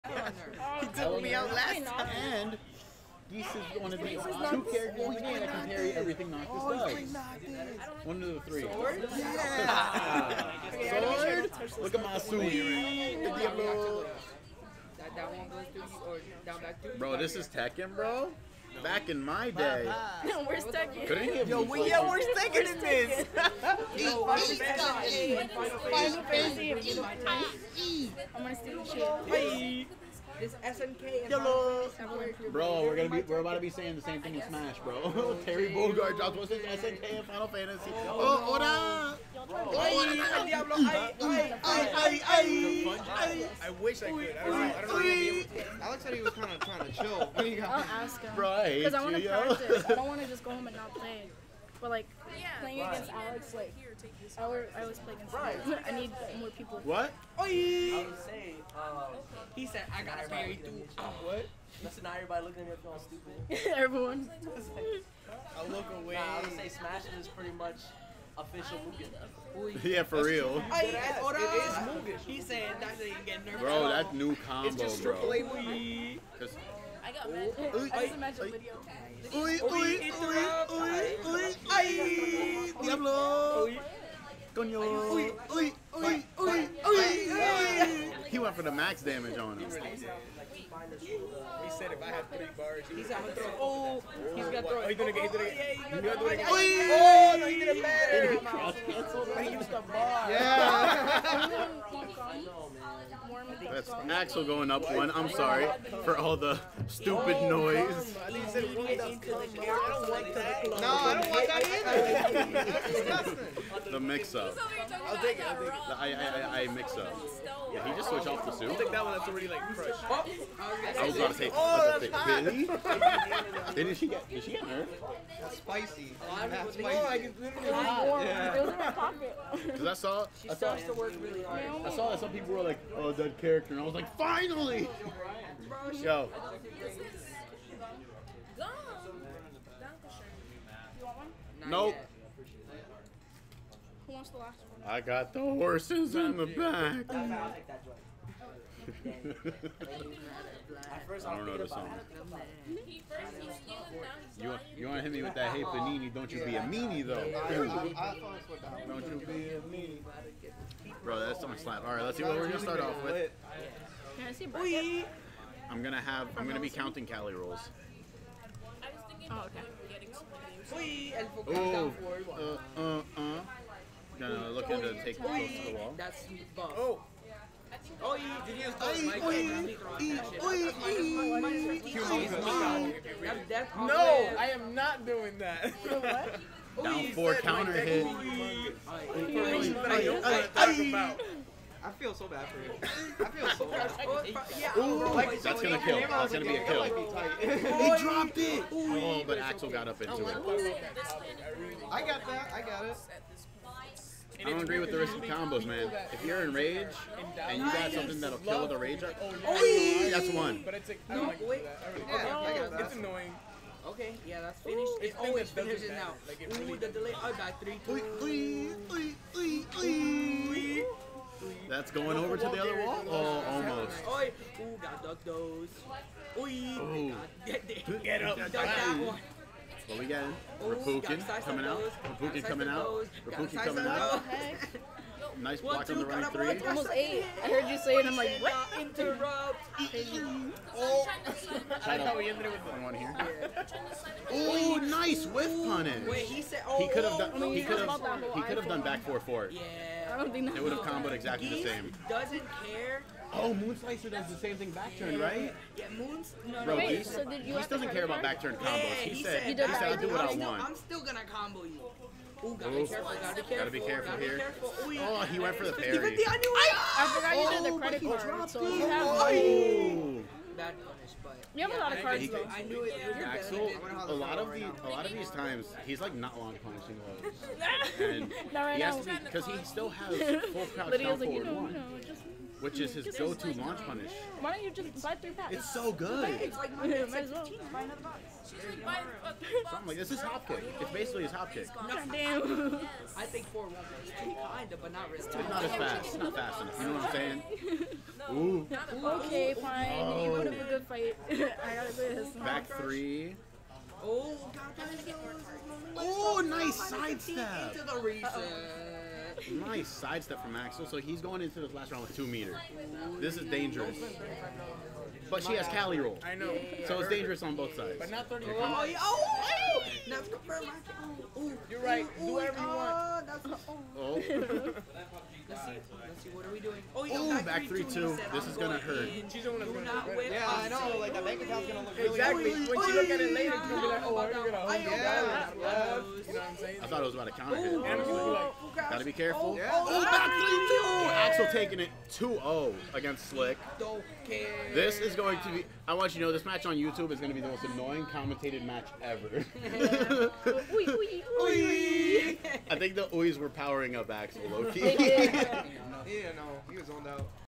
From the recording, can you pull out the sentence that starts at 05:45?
I want you to know, this match on YouTube is going to be the most annoying commentated match ever.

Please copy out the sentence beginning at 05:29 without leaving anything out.
She's gonna do not whip Yeah, I know.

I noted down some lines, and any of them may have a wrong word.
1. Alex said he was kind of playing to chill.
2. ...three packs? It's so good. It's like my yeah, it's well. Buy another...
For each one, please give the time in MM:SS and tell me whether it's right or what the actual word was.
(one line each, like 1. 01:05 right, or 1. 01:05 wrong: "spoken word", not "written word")
1. 00:45 wrong: "trying", not "playing"
2. 04:45 right.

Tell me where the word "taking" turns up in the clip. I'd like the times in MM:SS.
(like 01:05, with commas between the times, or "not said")
05:41.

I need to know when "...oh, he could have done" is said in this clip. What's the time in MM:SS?
04:06.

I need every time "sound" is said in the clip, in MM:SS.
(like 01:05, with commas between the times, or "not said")
not said.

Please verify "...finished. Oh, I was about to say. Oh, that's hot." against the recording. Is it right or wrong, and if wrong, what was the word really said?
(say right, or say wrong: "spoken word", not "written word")
wrong: "crushed", not "finished".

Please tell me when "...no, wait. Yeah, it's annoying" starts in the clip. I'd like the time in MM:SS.
03:31.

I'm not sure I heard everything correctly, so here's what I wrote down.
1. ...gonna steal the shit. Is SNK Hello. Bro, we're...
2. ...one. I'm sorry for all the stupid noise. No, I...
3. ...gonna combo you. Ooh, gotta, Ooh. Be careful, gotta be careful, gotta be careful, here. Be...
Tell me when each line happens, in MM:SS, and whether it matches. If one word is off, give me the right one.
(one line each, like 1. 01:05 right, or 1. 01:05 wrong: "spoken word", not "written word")
1. 00:28 right
2. 01:44 right
3. 04:21 right.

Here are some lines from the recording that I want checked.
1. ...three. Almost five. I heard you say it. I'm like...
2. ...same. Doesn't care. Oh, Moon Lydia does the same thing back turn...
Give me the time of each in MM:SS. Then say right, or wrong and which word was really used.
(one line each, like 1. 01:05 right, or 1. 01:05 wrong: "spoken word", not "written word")
1. 03:56 wrong: "eight", not "five"
2. 04:11 wrong: "Slicer", not "Lydia".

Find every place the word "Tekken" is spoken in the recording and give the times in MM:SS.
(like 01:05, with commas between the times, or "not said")
00:17.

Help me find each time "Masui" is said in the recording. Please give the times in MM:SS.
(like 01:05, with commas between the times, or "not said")
00:12.